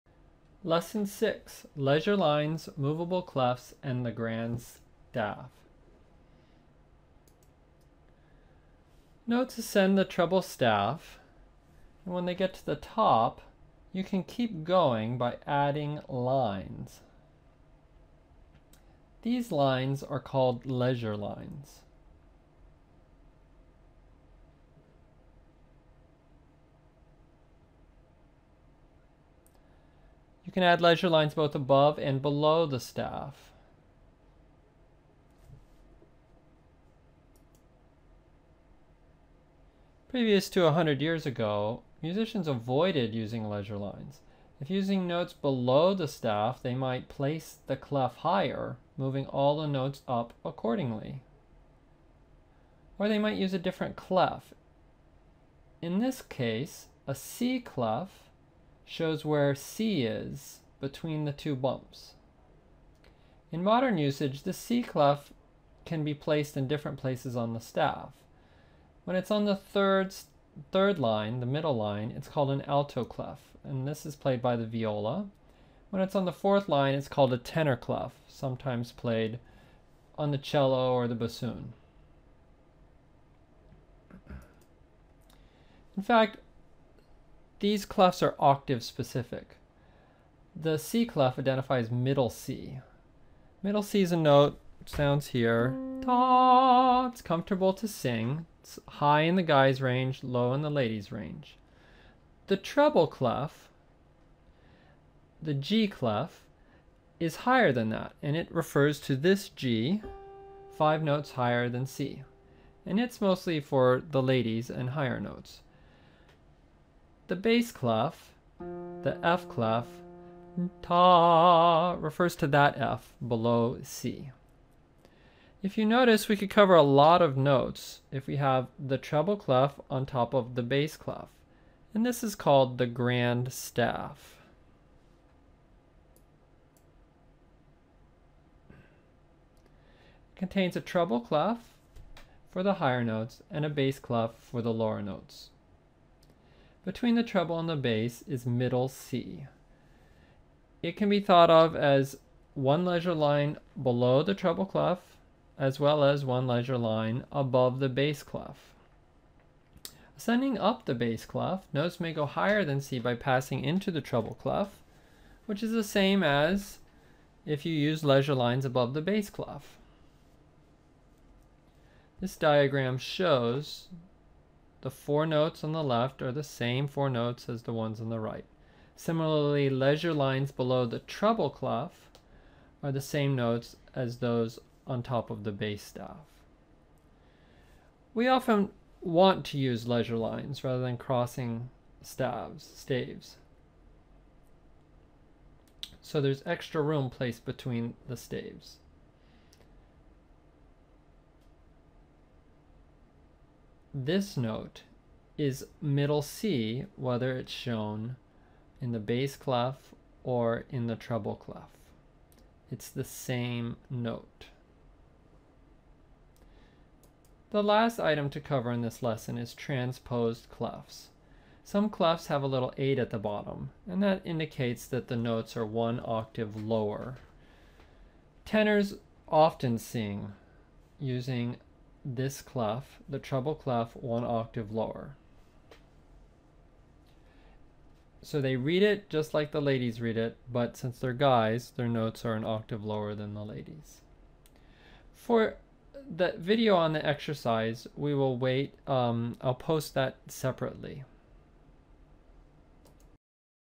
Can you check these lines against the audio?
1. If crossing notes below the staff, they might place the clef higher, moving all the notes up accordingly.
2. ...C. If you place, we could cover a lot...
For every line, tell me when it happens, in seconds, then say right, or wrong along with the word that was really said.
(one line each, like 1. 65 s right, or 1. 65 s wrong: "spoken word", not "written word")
1. 44 s wrong: "using", not "crossing"
2. 123 s wrong: "notice", not "place".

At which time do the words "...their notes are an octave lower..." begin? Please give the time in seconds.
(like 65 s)
241 s.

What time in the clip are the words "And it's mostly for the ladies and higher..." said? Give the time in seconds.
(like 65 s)
112 s.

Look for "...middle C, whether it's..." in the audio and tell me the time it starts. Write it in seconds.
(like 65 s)
205 s.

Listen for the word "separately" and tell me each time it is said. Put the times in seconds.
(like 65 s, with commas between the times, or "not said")
250 s.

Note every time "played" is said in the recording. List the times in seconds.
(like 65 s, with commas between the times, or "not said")
74 s, 78 s.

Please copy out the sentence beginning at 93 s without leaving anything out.
Middle C is a note, sounds here.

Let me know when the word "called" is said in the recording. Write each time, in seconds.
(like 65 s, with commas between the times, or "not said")
20 s, 72 s, 77 s, 132 s.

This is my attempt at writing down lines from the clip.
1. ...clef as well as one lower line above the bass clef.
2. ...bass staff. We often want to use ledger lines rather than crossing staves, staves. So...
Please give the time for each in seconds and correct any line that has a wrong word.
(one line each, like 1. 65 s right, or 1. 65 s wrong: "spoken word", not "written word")
1. 154 s wrong: "ledger", not "lower"
2. 185 s right.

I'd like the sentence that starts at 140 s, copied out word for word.
It contains a treble clef for the higher notes and a bass clef for the lower notes.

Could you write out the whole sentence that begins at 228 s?
Tenors often sing using this clef, the treble clef, one octave lower.